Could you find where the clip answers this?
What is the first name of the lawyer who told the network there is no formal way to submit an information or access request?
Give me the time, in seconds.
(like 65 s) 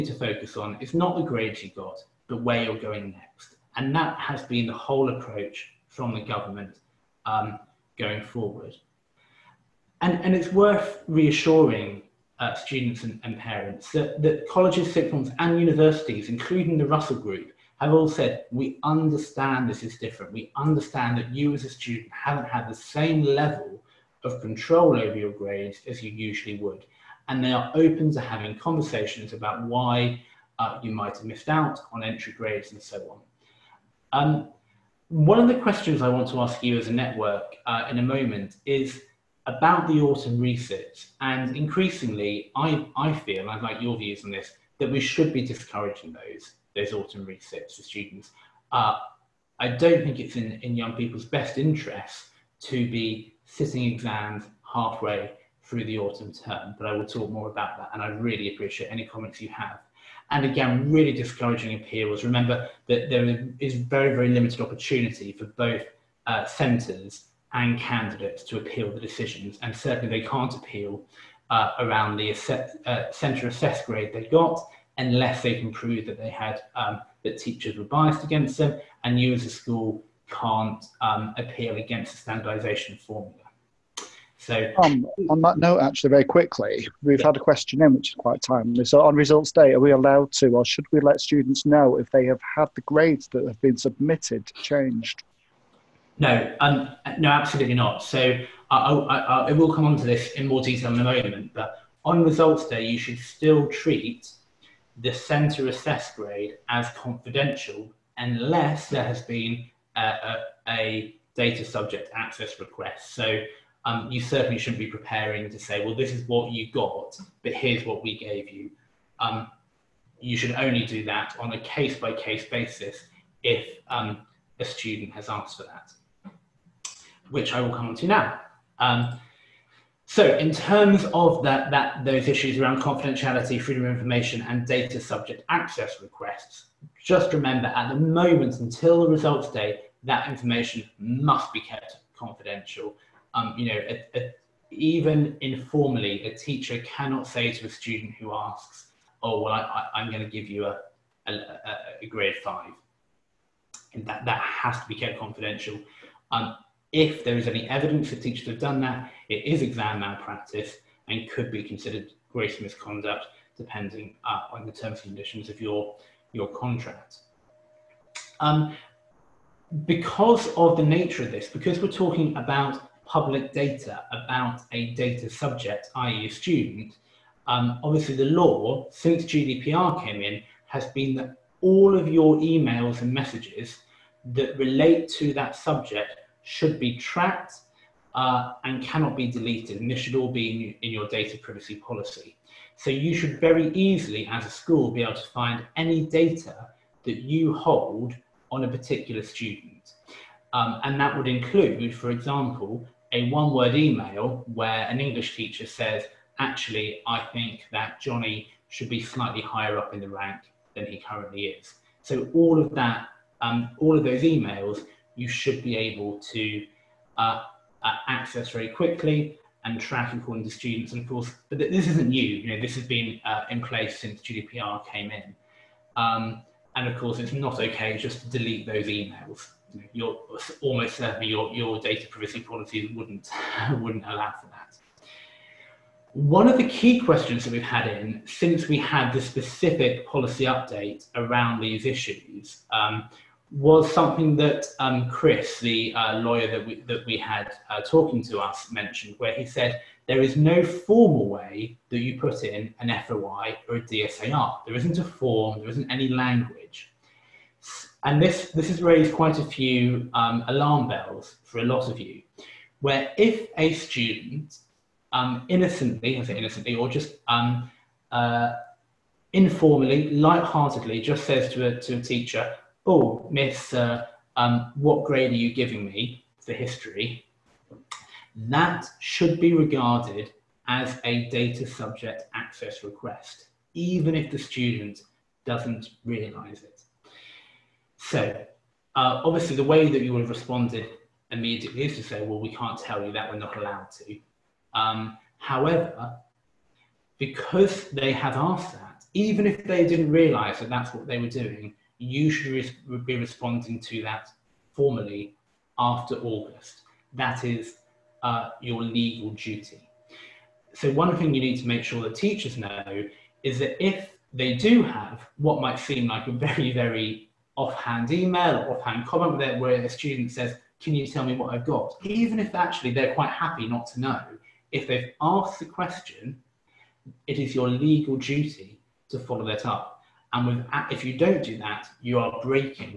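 245 s.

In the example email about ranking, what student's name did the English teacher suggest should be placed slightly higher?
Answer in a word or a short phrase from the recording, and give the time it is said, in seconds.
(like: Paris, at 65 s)
Johnny, at 207 s.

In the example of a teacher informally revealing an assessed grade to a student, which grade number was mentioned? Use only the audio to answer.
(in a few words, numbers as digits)
5.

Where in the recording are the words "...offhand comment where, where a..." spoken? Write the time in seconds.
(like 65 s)
318 s.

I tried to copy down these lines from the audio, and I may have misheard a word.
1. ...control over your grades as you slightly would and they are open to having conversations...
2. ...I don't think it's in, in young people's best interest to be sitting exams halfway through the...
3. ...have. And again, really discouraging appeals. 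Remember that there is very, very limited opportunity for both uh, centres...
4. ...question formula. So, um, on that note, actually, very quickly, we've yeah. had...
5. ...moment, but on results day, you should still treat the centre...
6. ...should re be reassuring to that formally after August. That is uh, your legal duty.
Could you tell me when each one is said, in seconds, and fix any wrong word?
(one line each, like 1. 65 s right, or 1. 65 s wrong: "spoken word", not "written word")
1. 24 s wrong: "usually", not "slightly"
2. 49 s right
3. 59 s right
4. 82 s wrong: "standardisation", not "question"
5. 101 s right
6. 302 s wrong: "responding", not "reassuring".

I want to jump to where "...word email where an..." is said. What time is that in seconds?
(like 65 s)
203 s.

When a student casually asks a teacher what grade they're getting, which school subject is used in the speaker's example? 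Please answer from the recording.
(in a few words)
History.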